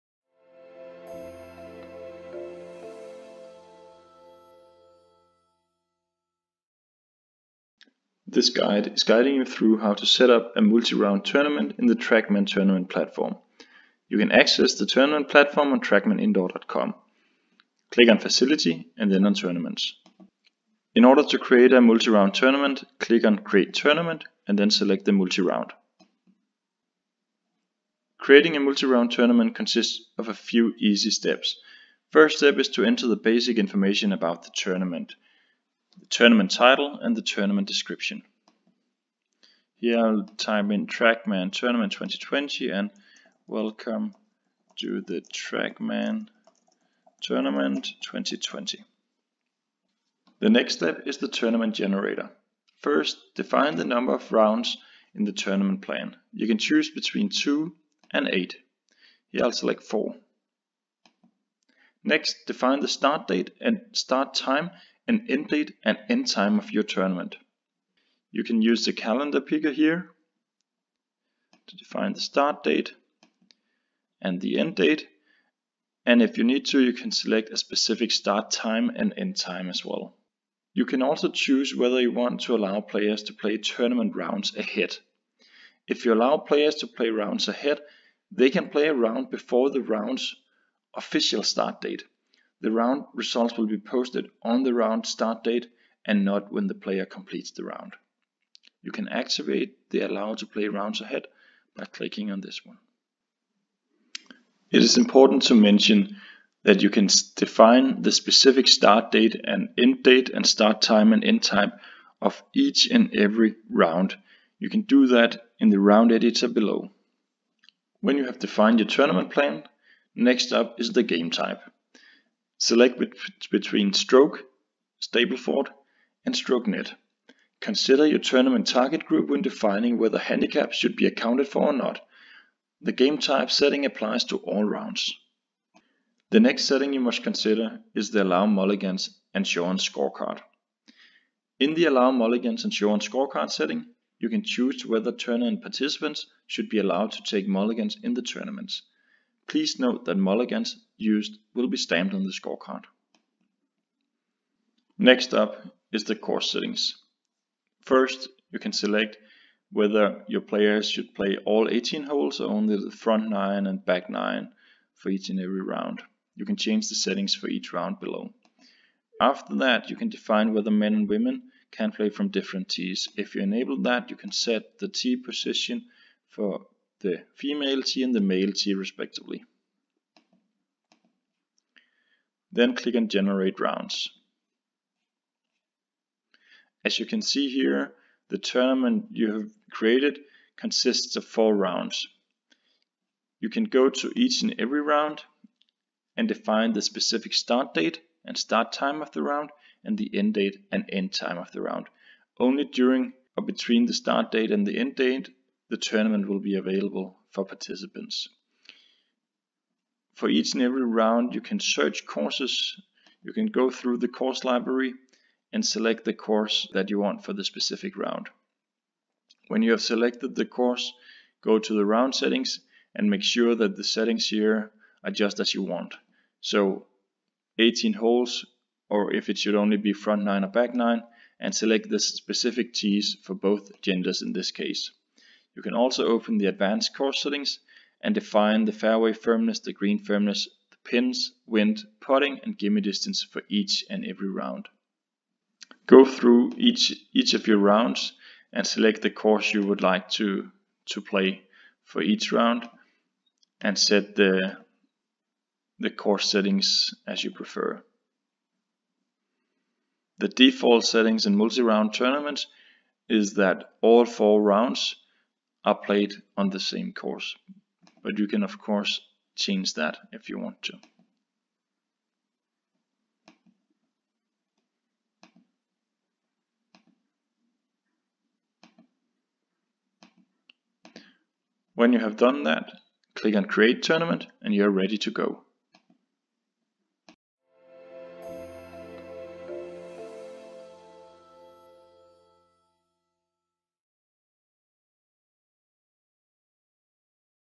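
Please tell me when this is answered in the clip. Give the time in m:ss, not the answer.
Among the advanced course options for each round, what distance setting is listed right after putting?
4:02.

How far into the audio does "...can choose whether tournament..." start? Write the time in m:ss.
2:24.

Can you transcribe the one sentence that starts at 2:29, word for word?
Please note that mulligans used will be stamped on the scorecard.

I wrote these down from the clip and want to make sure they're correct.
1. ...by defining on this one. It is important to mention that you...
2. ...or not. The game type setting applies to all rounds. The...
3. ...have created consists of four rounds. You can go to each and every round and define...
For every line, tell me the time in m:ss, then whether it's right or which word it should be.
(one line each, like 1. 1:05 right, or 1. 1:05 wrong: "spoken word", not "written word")
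1. 1:41 wrong: "clicking", not "defining"
2. 2:11 right
3. 3:09 right.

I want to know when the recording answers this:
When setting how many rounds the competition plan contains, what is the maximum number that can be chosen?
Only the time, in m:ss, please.
0:58.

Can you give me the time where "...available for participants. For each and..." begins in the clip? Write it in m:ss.
3:26.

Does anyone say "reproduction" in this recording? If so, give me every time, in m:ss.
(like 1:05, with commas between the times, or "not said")
not said.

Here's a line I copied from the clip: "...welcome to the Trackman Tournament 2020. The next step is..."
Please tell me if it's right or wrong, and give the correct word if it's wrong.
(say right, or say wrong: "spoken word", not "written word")
right.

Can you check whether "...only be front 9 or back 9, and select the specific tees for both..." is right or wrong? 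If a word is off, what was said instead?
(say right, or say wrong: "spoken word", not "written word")
right.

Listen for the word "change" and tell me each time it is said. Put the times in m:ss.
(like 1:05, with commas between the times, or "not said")
2:46, 4:29.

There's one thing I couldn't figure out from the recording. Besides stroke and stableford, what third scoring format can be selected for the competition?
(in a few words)
Stroke net.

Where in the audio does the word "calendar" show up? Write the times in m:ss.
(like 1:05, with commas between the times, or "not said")
1:08.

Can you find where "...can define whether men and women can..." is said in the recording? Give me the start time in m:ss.
2:49.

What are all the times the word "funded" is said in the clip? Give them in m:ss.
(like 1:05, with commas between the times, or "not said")
not said.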